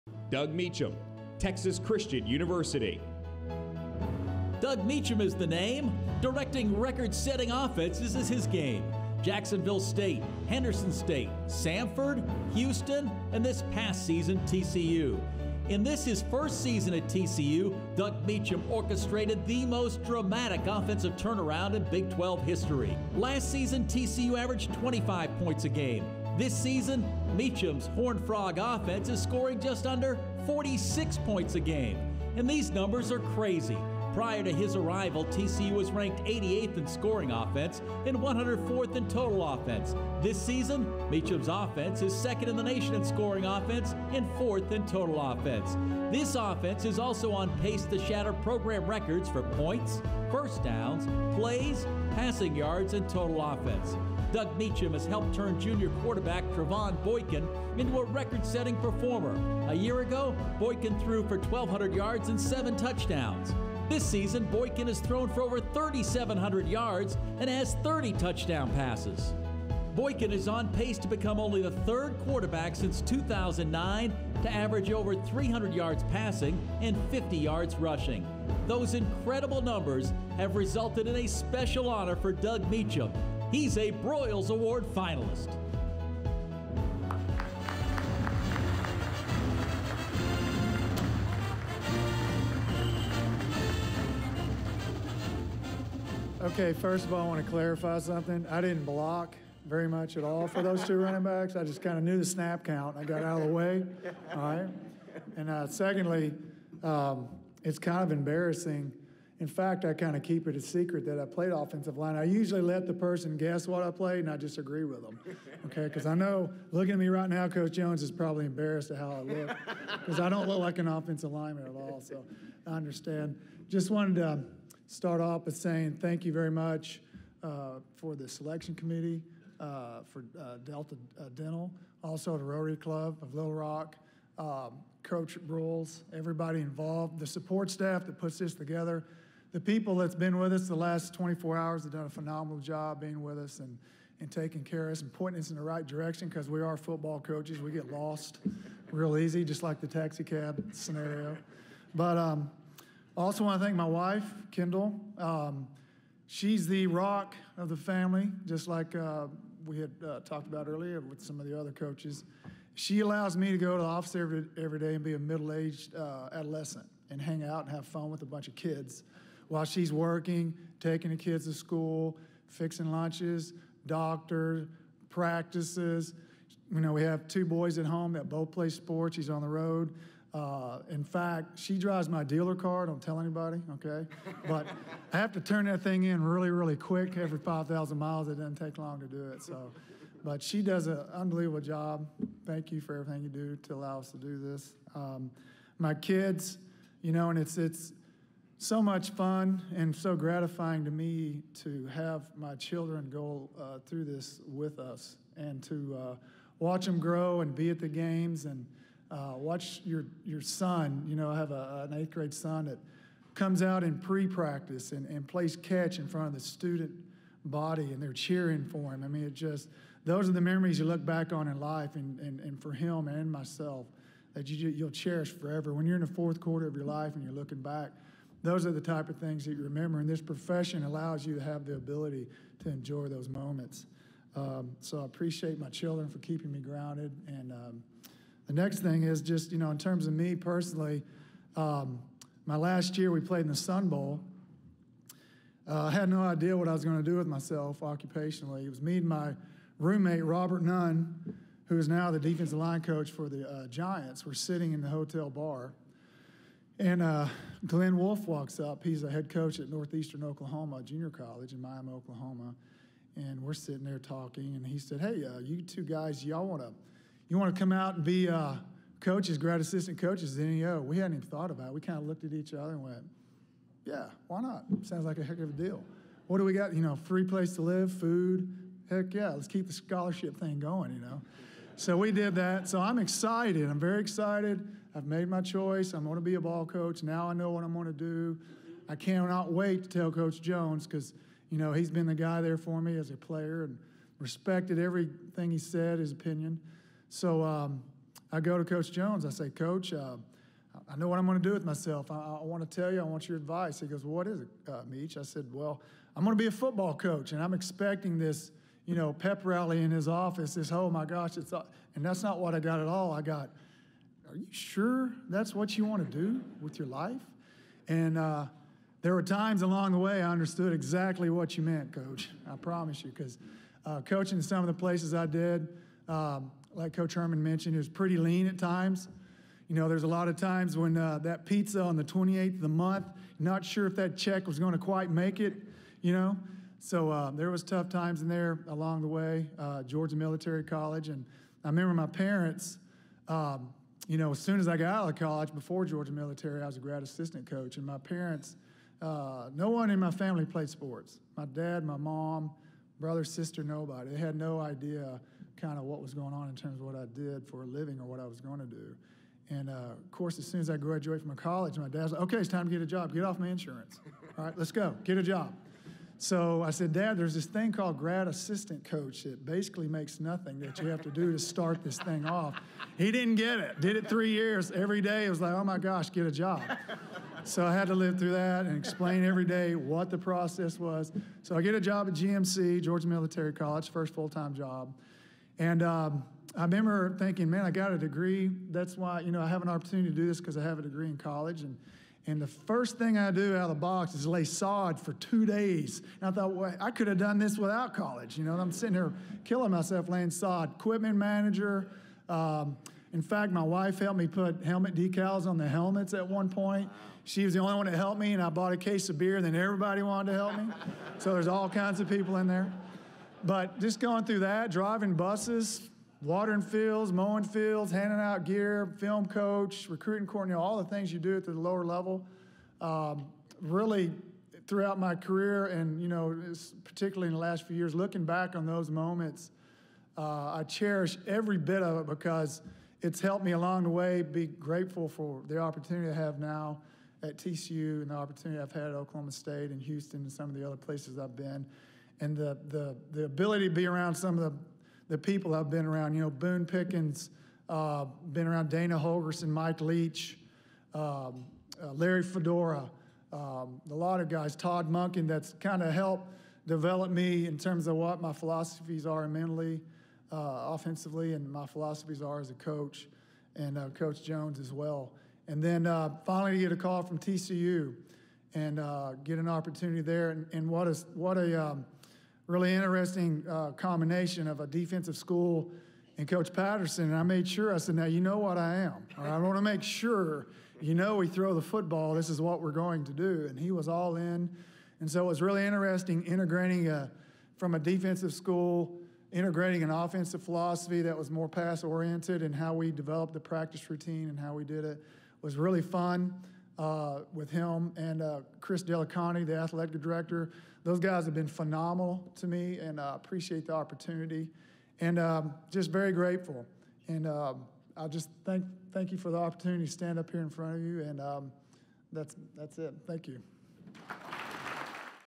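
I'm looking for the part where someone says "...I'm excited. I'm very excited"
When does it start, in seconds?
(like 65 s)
282 s.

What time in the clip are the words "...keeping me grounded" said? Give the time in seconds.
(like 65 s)
236 s.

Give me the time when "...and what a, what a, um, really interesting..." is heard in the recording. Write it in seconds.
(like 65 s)
470 s.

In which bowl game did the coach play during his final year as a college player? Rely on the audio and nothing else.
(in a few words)
Sun Bowl.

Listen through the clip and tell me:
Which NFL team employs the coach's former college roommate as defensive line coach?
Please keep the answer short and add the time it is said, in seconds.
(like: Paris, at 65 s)
Giants, at 253 s.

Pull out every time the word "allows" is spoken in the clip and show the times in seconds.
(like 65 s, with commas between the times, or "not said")
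163 s, 193 s, 230 s.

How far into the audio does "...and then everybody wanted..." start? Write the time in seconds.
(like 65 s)
409 s.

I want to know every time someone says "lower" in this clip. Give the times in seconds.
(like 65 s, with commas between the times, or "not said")
421 s.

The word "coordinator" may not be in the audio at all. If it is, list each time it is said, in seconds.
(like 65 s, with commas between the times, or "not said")
420 s.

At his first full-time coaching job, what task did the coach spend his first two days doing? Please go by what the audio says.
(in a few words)
Laying sod.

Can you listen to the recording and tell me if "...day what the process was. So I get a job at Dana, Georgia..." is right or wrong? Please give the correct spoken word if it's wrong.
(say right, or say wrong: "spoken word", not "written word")
wrong: "GMC", not "Dana".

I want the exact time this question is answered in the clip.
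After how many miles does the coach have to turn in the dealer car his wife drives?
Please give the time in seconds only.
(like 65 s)
187 s.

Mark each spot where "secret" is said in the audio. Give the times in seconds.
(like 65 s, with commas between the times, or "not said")
110 s.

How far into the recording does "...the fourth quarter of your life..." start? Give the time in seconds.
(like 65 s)
226 s.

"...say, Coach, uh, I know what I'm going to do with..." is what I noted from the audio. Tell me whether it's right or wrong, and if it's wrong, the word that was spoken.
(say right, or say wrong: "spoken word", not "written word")
right.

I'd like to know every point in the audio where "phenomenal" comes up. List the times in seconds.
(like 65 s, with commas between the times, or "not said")
142 s, 501 s.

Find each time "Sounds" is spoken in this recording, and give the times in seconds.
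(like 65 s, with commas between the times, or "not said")
274 s.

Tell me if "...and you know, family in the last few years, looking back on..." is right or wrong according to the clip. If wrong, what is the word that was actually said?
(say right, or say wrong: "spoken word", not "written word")
wrong: "particularly", not "family".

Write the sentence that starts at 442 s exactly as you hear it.
And the, the, the ability to be around some of the the people I've been around.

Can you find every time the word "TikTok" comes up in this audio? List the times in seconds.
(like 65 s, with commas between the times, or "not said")
not said.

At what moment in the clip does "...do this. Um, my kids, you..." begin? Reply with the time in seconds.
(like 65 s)
194 s.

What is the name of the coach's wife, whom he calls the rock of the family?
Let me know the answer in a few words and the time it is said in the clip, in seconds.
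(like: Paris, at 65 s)
Kendall, at 154 s.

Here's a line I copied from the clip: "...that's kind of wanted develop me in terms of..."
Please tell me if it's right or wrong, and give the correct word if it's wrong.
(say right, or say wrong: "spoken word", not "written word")
wrong: "helped", not "wanted".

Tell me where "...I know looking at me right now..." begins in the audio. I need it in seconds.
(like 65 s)
116 s.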